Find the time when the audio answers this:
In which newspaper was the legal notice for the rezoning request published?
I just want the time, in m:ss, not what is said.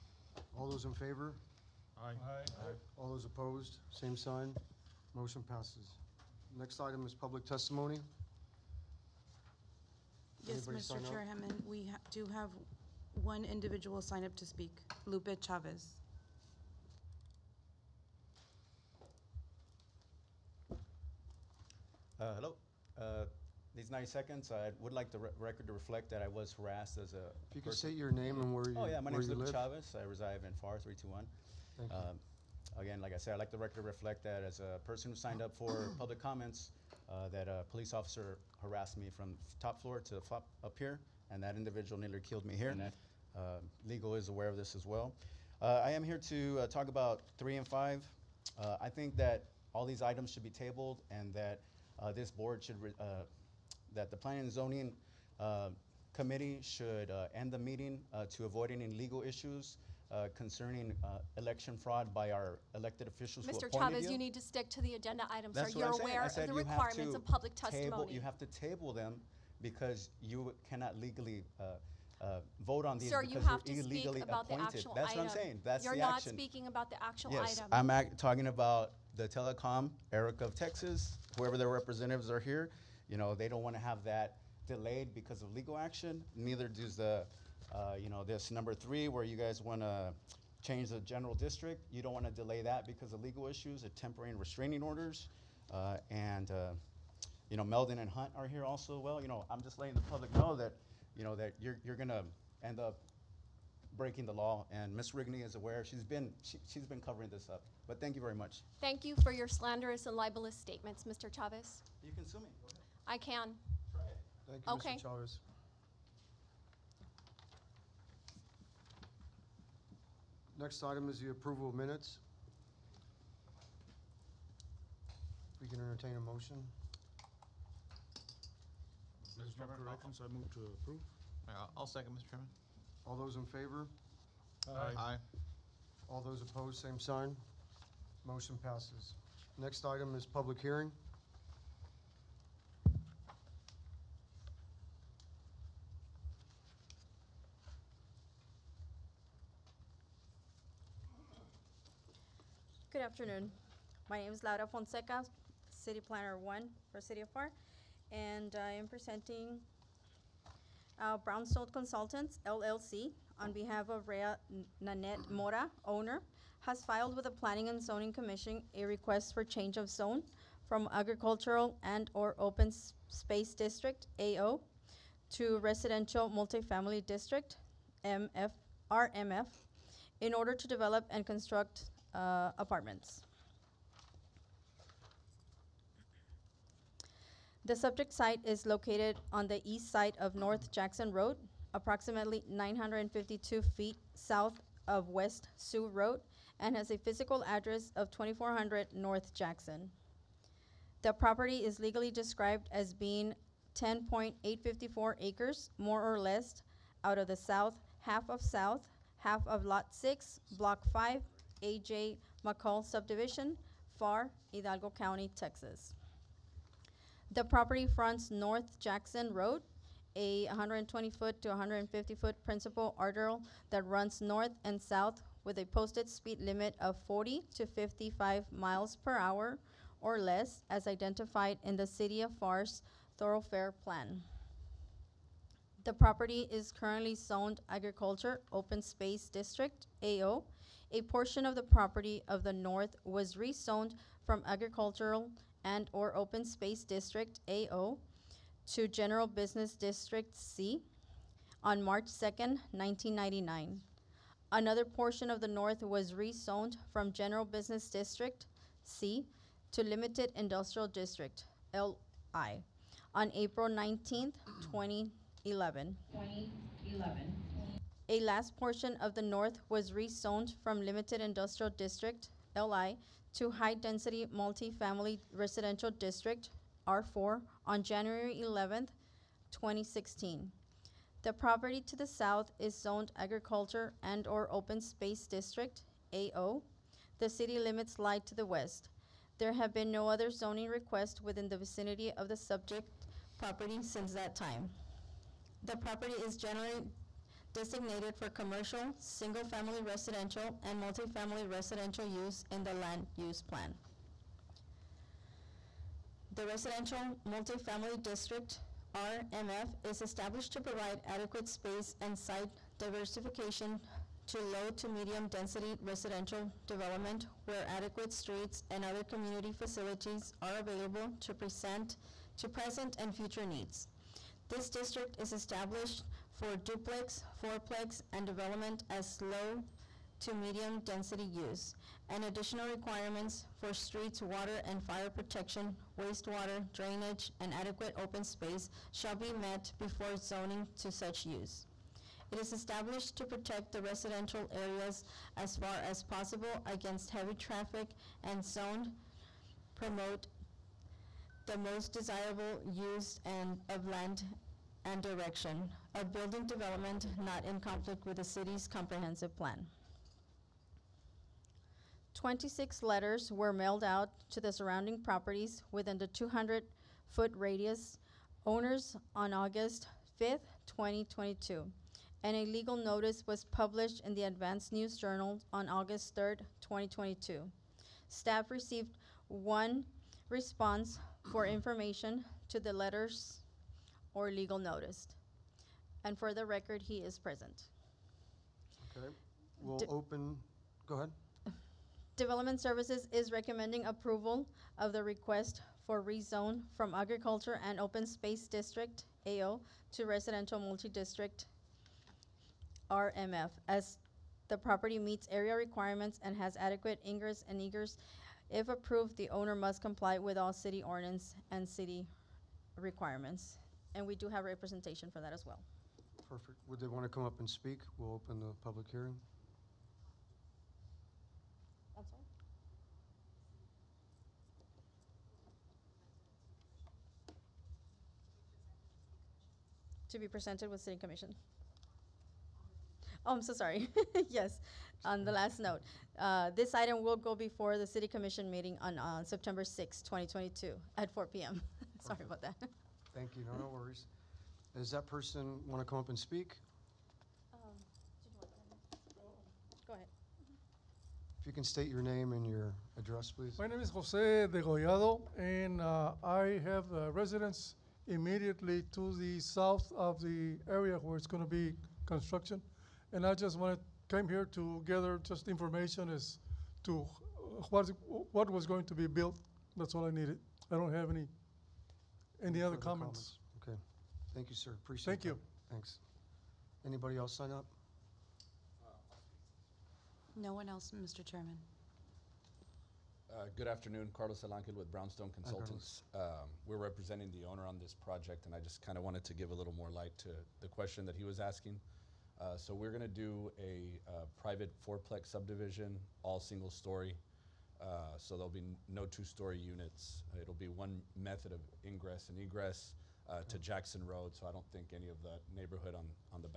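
6:14.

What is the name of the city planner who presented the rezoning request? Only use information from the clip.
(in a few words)
Laura Fonseca.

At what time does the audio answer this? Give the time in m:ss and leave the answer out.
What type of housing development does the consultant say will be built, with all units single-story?
8:14.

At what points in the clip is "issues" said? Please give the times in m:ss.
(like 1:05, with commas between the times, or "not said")
0:59, 1:33.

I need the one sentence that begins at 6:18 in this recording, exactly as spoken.
Staff received one response for information to the letters or legal notice.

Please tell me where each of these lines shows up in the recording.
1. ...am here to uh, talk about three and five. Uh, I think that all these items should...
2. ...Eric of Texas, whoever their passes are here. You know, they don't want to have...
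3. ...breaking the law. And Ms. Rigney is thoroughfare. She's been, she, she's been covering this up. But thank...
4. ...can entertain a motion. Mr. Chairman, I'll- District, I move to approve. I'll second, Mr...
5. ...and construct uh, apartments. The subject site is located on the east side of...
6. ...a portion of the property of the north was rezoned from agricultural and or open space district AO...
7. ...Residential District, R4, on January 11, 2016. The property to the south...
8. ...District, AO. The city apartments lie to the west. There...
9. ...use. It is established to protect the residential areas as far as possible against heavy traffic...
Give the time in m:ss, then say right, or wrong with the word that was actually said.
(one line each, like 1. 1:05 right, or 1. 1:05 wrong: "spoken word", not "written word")
1. 0:45 right
2. 1:20 wrong: "representatives", not "passes"
3. 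1:43 wrong: "aware", not "thoroughfare"
4. 2:05 wrong: "Directions", not "District"
5. 3:01 right
6. 4:00 right
7. 4:35 right
8. 4:45 wrong: "limits", not "apartments"
9. 5:41 right.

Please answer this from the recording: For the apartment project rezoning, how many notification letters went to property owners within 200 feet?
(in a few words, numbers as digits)
26.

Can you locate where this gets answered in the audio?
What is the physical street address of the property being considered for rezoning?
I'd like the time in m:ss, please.
3:18.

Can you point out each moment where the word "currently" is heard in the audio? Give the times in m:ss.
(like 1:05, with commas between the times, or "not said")
3:56.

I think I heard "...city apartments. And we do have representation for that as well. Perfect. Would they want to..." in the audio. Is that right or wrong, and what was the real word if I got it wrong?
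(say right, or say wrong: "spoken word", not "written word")
wrong: "requirements", not "apartments".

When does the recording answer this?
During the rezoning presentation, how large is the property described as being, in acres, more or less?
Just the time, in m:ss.
3:23.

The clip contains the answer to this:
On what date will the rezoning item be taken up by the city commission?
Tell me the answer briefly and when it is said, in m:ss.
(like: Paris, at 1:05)
September 6, 2022, at 7:19.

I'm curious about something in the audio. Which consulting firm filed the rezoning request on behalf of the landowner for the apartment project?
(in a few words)
Brownstone Consultants, LLC.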